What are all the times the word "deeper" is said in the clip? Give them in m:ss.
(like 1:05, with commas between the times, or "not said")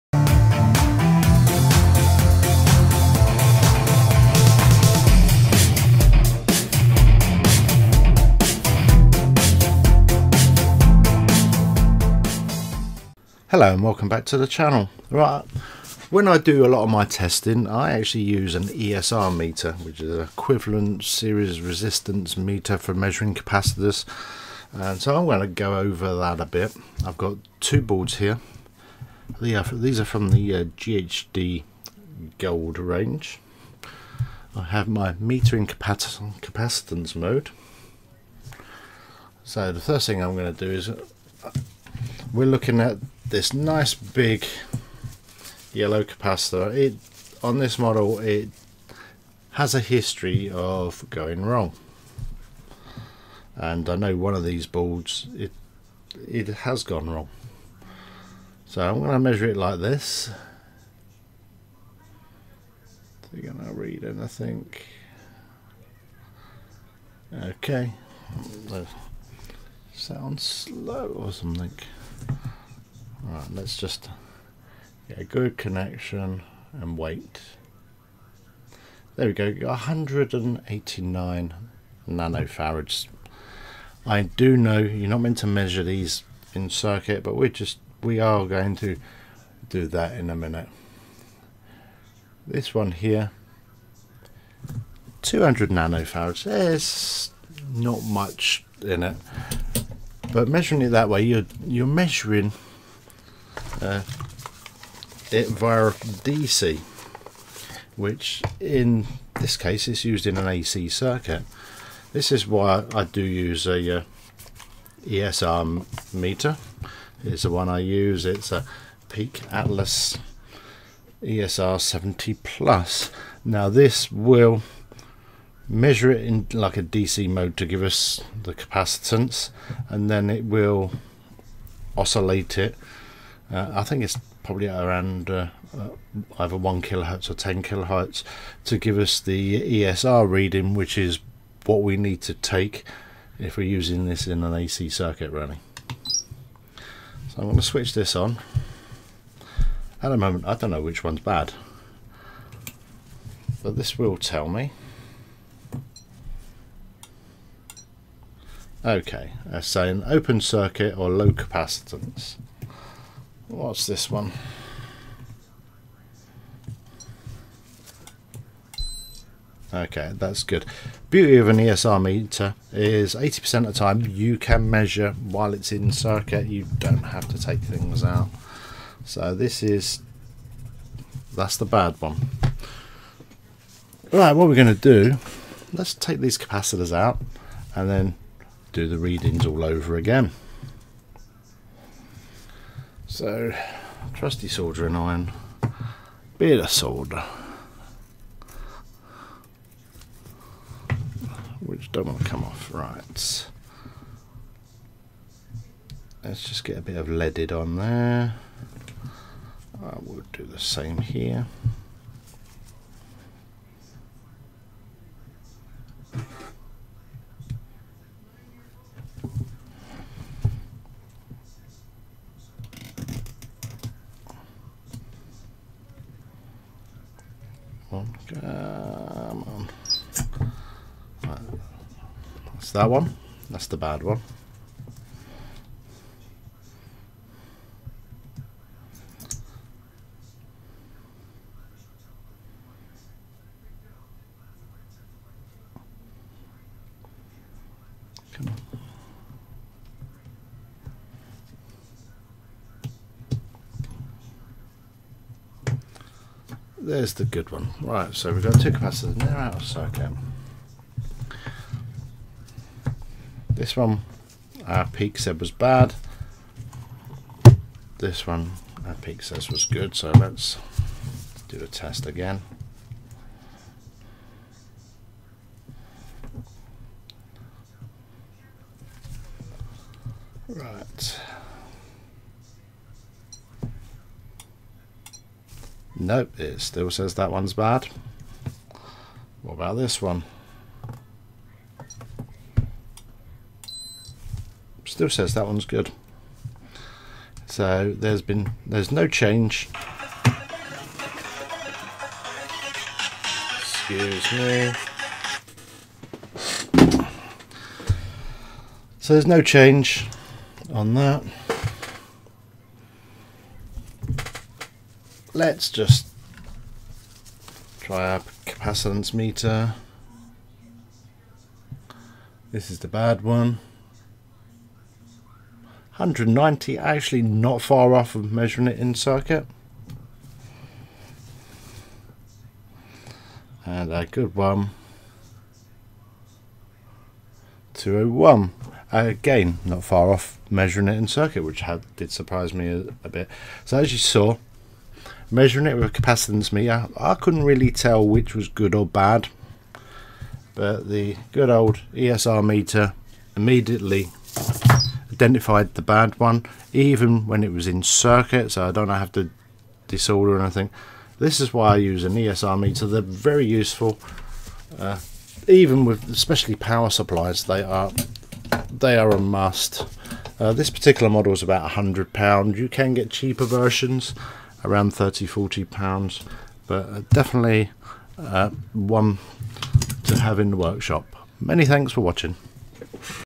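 not said.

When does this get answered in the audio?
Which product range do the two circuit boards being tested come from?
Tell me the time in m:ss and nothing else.
0:30.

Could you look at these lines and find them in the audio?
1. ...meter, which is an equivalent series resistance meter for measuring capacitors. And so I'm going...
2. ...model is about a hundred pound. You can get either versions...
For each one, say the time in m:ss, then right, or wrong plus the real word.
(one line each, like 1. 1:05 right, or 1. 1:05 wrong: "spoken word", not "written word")
1. 0:19 right
2. 6:11 wrong: "cheaper", not "either".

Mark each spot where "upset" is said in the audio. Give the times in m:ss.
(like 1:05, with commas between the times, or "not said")
not said.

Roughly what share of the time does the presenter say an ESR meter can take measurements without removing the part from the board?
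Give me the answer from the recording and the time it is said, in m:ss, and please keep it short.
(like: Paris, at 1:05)
80%, at 2:53.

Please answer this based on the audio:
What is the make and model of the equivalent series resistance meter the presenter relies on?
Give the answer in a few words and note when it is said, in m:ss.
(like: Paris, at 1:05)
Peak Atlas ESR 70 plus, at 1:59.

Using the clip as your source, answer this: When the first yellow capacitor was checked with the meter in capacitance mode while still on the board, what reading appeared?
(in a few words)
189 nanofarads.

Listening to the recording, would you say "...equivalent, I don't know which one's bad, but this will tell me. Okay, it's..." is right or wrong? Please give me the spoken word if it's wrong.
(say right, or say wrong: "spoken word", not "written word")
wrong: "moment", not "equivalent".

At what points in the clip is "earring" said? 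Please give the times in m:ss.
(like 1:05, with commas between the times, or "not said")
not said.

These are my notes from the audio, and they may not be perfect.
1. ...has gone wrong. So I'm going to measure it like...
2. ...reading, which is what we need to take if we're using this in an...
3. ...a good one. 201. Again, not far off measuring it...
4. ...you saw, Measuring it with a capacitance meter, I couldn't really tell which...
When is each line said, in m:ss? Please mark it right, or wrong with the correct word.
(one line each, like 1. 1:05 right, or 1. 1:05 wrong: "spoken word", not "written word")
1. 0:56 right
2. 2:20 right
3. 5:33 right
4. 5:43 right.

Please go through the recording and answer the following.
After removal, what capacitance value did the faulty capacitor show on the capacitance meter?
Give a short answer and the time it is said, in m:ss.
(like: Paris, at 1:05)
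190, at 5:25.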